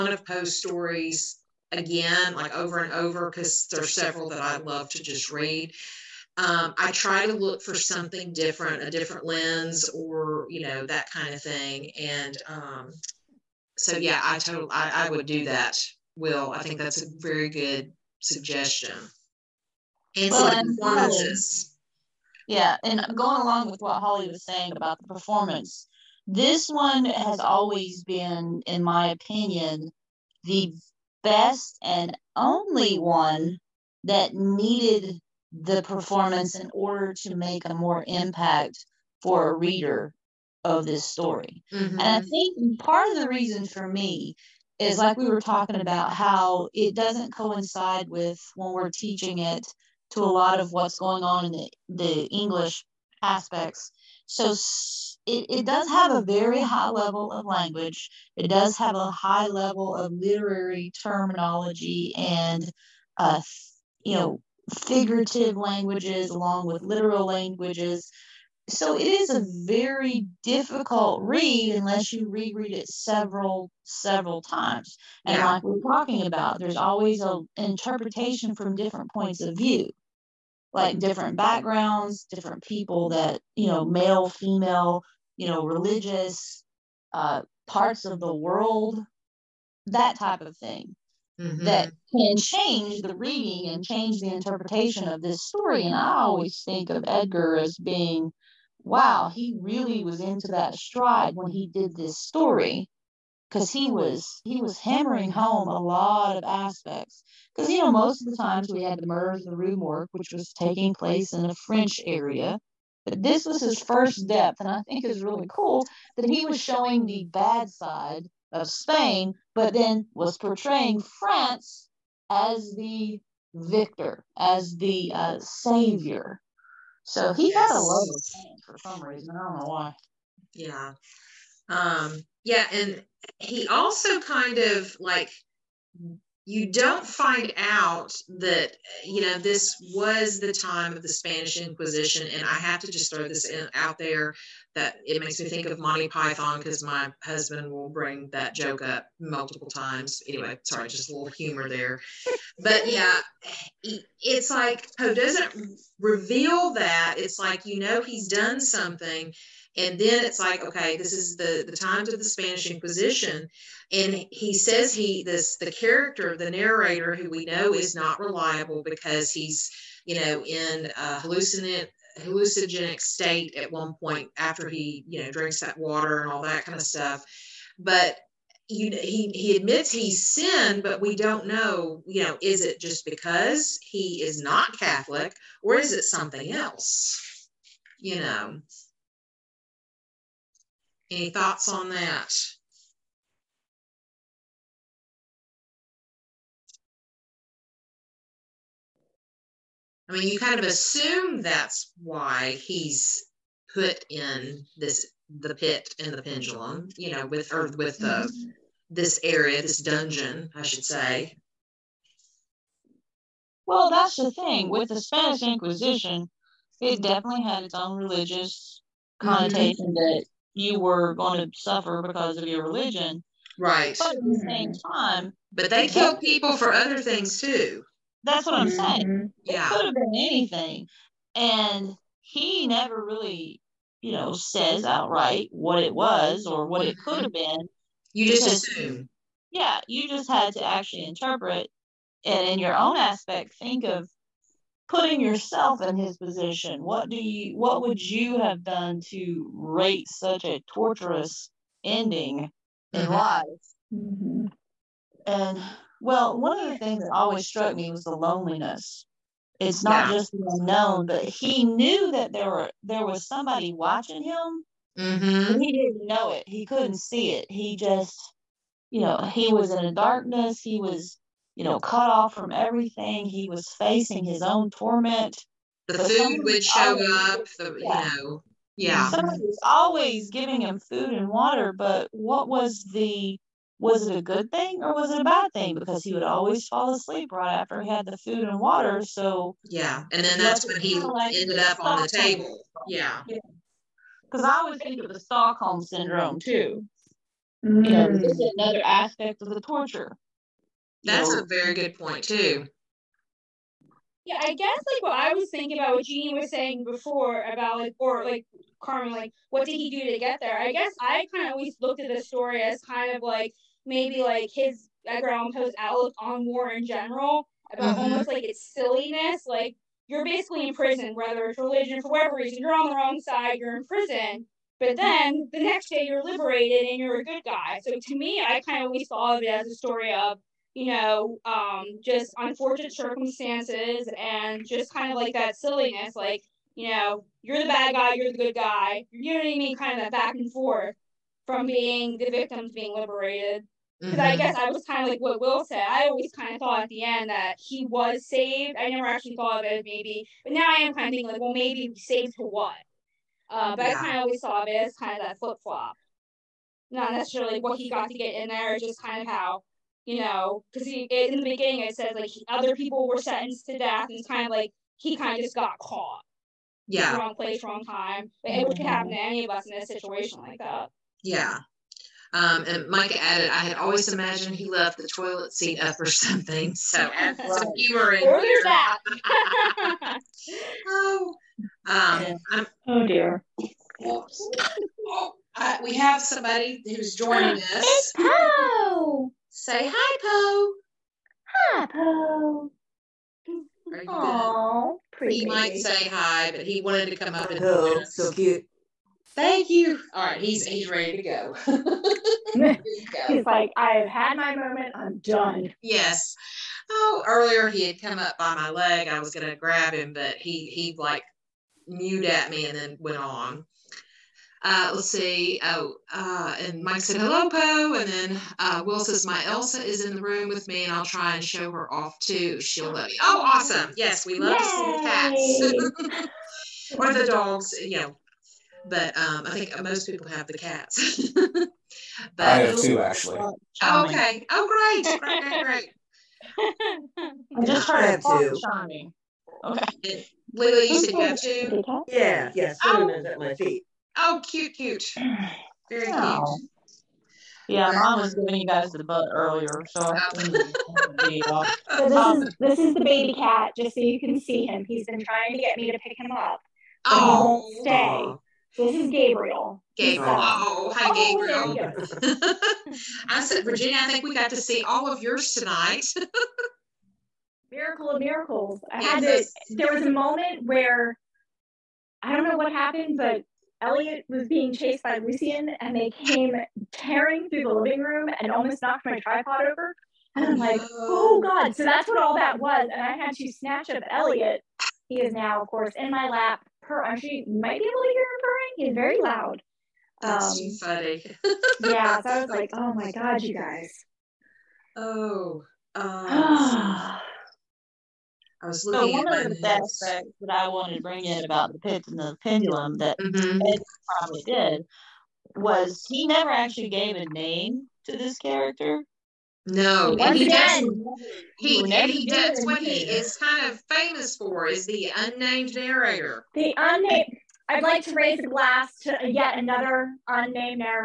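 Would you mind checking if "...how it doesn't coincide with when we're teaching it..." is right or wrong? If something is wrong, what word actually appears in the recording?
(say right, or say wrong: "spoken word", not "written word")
right.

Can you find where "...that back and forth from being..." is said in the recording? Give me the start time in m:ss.
5:40.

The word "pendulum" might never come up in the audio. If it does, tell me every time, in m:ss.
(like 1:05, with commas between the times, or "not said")
3:26, 8:22.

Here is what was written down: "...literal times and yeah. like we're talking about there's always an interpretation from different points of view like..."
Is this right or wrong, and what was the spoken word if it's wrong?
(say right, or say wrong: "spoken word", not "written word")
wrong: "several", not "literal".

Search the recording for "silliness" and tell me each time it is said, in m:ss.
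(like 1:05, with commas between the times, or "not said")
5:18, 5:35.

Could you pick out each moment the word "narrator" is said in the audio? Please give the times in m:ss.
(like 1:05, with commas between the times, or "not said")
2:46, 8:35.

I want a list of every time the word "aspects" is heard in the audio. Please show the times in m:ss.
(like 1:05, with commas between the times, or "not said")
0:53, 1:46, 4:02, 4:58, 8:19.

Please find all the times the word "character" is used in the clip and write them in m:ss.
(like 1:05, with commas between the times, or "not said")
2:45, 8:28.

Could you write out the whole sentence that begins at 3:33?
Well, that's the thing with the Spanish Inquisition; it definitely had its own religious connotation mm-hmm.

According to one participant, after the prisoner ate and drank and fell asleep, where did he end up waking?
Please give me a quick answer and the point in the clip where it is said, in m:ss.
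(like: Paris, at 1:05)
On the table, at 4:50.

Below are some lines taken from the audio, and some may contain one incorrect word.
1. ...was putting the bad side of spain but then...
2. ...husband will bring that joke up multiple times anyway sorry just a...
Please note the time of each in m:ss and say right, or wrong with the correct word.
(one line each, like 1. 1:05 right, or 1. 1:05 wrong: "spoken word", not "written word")
1. 1:56 wrong: "showing", not "putting"
2. 2:27 right.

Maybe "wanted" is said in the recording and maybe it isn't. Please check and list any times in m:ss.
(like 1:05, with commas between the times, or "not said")
6:36, 8:20.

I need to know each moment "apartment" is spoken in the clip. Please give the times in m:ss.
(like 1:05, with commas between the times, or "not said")
not said.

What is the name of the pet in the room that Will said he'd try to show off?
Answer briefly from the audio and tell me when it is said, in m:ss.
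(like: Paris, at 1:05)
Elsa, at 6:59.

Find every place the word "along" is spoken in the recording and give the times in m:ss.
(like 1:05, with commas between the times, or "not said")
0:23, 1:06.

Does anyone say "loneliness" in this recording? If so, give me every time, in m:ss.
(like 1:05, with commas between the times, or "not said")
4:18.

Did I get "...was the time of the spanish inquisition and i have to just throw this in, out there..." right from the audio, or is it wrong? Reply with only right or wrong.
right.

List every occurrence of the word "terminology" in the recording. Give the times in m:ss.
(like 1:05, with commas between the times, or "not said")
1:01.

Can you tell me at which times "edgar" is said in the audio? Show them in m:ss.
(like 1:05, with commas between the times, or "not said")
1:37, 5:15.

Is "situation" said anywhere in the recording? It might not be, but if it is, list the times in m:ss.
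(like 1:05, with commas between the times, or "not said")
6:09.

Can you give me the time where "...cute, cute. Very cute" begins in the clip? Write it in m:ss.
7:24.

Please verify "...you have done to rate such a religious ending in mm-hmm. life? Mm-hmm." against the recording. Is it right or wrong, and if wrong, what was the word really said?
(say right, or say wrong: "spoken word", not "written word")
wrong: "torturous", not "religious".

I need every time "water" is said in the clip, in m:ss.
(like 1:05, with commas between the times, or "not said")
2:55, 4:41, 4:48.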